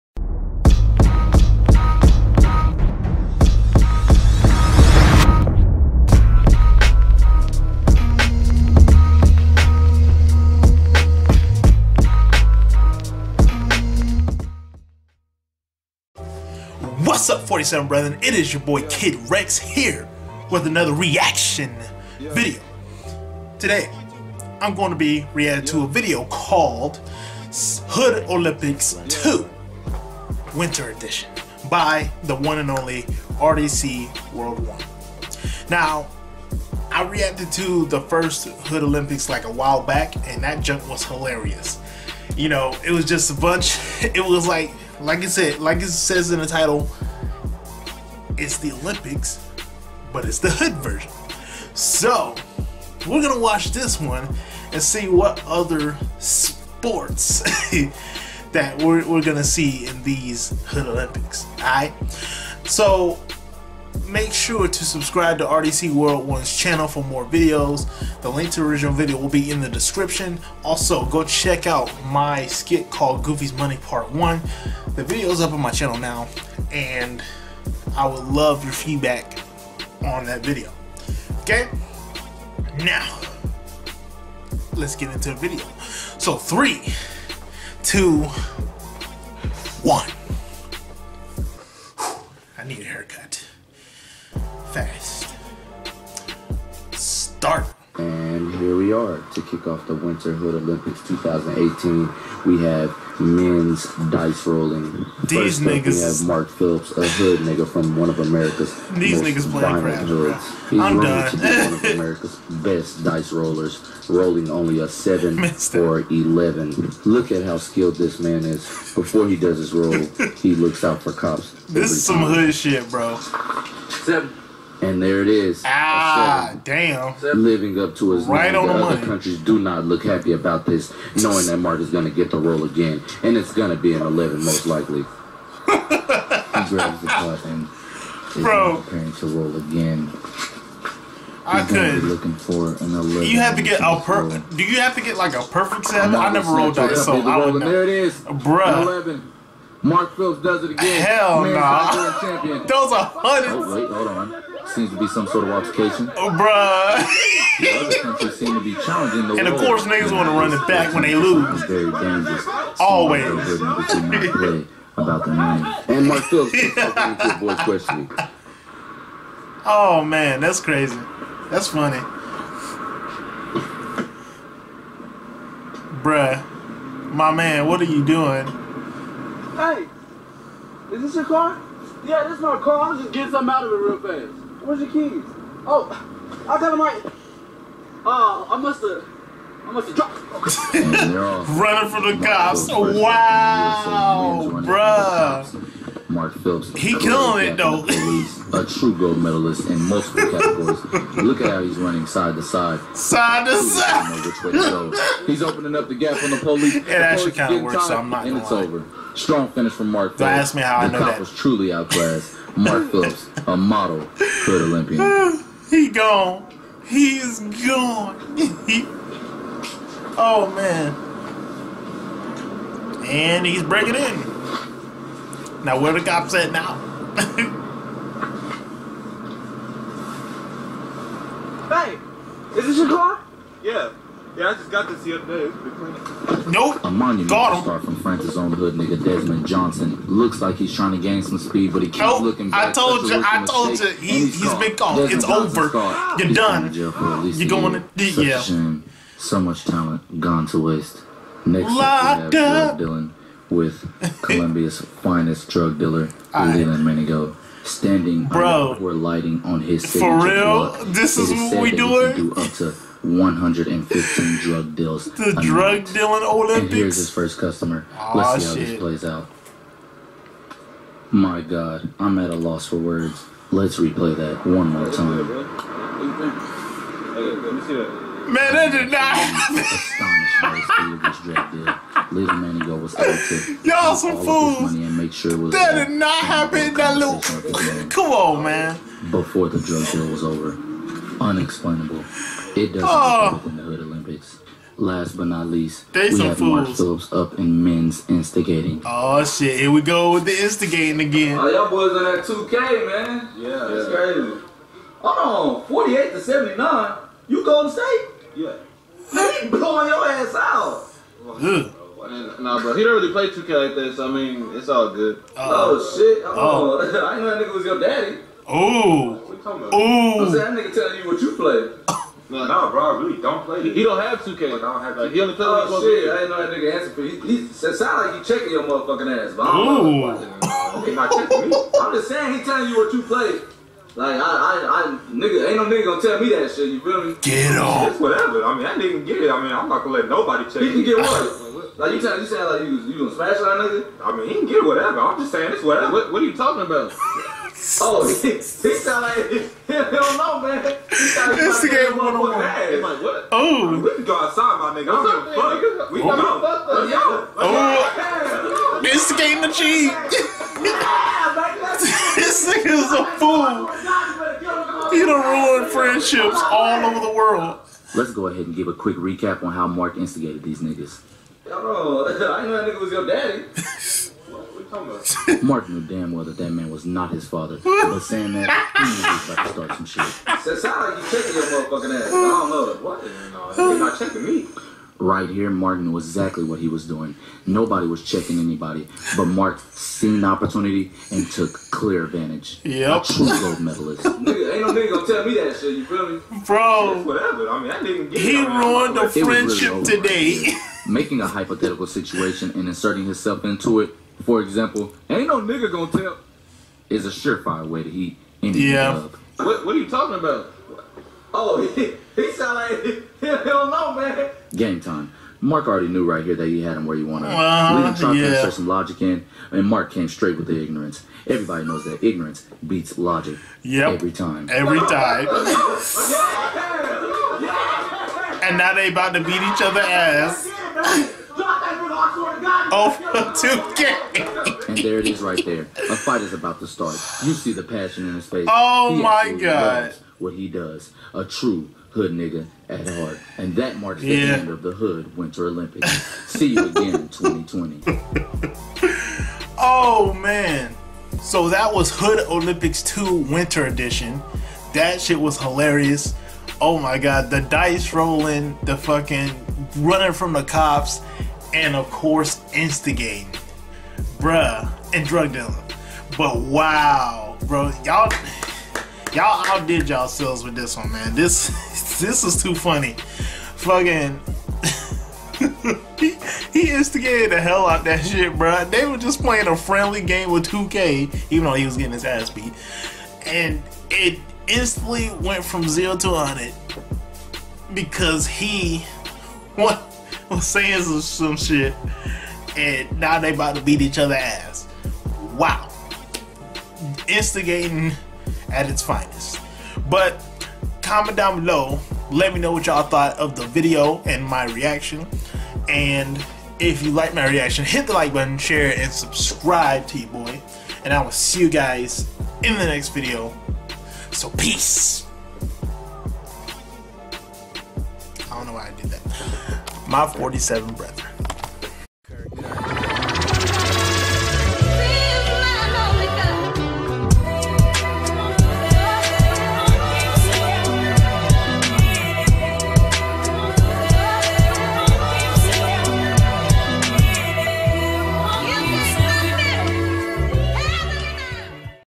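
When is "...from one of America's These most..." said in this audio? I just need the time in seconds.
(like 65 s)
107 s.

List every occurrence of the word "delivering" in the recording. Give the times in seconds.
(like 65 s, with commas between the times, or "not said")
not said.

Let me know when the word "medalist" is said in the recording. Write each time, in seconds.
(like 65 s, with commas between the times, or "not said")
199 s, 393 s.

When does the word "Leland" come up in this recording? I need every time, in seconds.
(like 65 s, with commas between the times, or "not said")
256 s.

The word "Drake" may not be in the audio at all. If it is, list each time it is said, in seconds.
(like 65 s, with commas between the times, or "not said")
not said.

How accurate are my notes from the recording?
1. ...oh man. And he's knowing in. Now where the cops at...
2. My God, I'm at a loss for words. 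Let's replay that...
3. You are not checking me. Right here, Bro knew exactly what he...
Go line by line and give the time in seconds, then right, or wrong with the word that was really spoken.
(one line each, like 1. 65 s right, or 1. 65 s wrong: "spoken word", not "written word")
1. 220 s wrong: "breaking", not "knowing"
2. 271 s right
3. 383 s wrong: "Mark", not "Bro".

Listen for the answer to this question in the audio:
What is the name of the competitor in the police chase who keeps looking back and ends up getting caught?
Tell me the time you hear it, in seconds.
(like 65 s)
239 s.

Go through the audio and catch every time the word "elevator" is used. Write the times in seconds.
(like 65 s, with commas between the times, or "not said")
not said.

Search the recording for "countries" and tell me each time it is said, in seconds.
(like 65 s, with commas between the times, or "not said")
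129 s, 157 s.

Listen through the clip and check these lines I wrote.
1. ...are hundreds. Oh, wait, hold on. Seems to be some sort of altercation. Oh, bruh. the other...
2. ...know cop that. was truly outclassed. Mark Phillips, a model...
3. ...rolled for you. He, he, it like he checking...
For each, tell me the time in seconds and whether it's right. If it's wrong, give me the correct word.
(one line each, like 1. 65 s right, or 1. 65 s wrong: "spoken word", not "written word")
1. 152 s right
2. 210 s right
3. 326 s wrong: "answered", not "rolled".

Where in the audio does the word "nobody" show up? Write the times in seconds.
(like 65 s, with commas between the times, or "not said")
340 s, 387 s.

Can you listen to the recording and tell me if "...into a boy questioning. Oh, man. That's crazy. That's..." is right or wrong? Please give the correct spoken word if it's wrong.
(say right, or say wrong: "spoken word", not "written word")
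right.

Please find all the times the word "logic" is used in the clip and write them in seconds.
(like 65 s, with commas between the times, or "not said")
418 s, 422 s.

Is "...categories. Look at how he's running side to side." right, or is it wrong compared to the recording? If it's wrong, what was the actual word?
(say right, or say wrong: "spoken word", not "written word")
right.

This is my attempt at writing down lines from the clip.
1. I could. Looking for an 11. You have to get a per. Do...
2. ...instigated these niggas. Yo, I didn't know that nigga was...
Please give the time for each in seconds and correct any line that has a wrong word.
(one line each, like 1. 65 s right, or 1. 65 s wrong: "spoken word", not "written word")
1. 141 s right
2. 369 s right.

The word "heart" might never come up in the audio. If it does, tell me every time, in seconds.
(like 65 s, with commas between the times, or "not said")
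442 s.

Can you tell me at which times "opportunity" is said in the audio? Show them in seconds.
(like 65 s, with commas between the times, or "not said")
390 s.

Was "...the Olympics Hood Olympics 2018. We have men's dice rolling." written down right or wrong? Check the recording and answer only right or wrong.
wrong.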